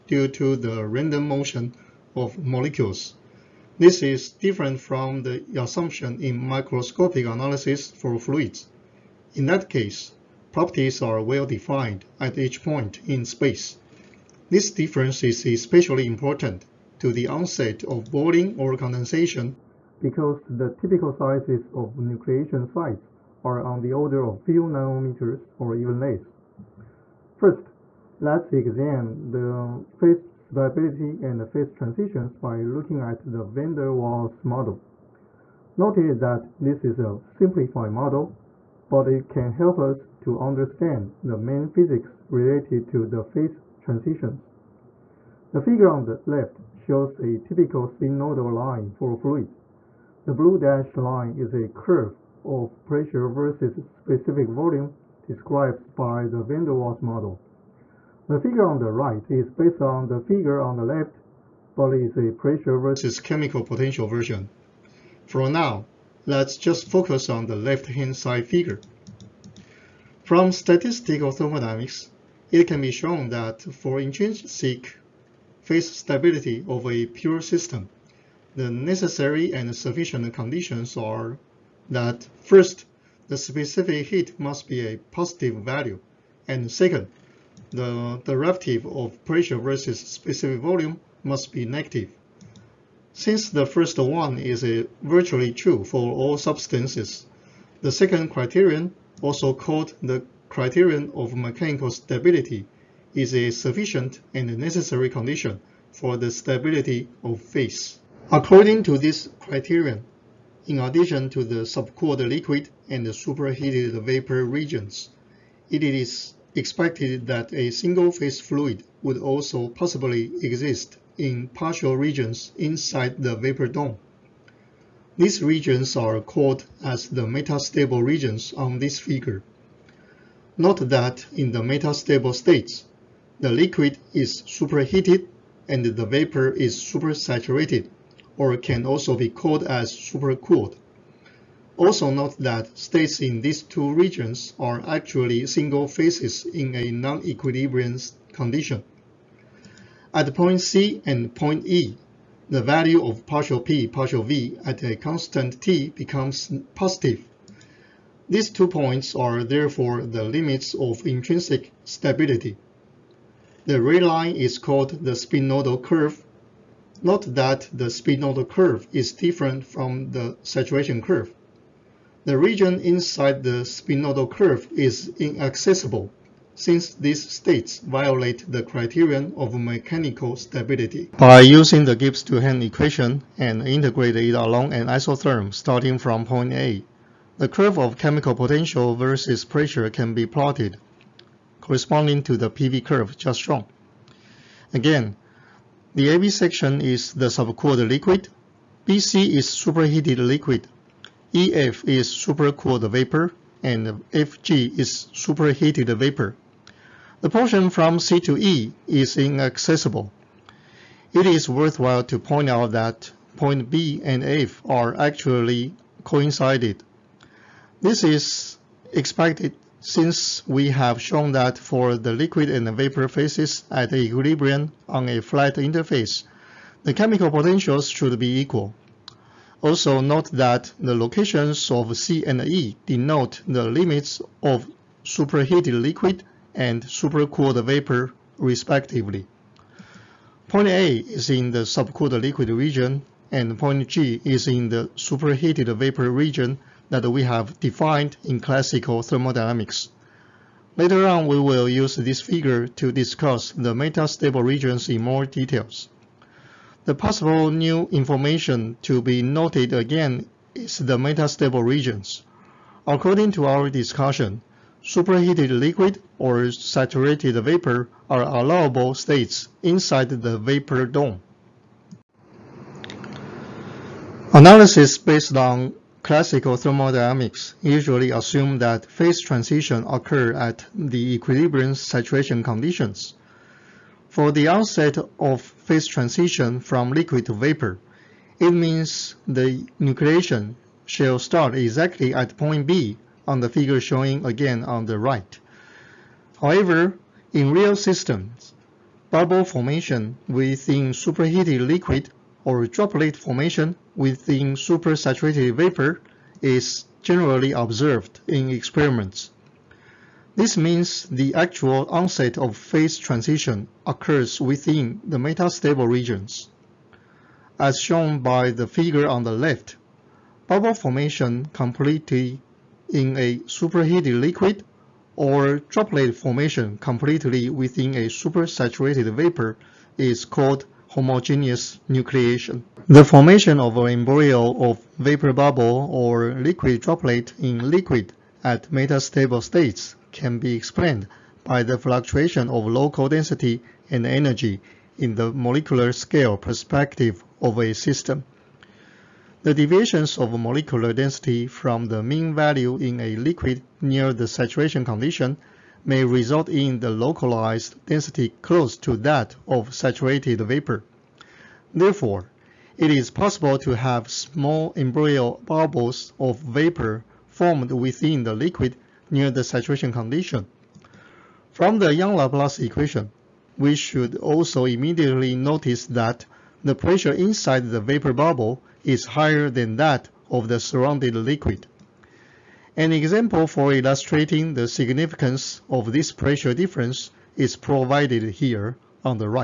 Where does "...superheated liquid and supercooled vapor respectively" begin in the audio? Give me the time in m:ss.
3:55.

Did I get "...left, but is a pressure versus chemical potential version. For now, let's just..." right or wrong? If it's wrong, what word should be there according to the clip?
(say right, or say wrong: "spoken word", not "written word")
right.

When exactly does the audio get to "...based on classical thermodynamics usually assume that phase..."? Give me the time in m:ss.
4:34.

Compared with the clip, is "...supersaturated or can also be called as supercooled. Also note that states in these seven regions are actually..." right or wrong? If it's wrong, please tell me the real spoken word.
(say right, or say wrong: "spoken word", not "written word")
wrong: "two", not "seven".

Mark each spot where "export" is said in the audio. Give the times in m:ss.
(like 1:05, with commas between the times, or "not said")
not said.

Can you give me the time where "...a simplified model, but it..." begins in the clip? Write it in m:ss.
0:36.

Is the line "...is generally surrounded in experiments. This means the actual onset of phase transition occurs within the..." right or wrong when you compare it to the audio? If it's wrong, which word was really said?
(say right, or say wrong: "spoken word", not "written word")
wrong: "observed", not "surrounded".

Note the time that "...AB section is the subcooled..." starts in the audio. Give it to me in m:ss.
3:16.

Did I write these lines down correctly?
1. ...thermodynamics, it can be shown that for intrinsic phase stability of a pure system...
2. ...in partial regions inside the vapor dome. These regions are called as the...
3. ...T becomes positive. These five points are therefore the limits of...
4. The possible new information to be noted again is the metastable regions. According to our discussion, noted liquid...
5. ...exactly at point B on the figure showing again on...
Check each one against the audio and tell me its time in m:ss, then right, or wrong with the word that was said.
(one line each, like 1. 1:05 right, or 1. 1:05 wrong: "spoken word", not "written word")
1. 1:11 right
2. 2:01 right
3. 2:35 wrong: "two", not "five"
4. 4:16 wrong: "superheated", not "noted"
5. 4:51 right.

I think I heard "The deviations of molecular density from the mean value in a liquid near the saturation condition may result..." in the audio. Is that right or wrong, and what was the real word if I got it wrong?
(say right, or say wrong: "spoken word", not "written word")
right.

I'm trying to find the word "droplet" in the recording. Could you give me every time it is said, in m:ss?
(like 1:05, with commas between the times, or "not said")
5:02, 5:25, 5:36.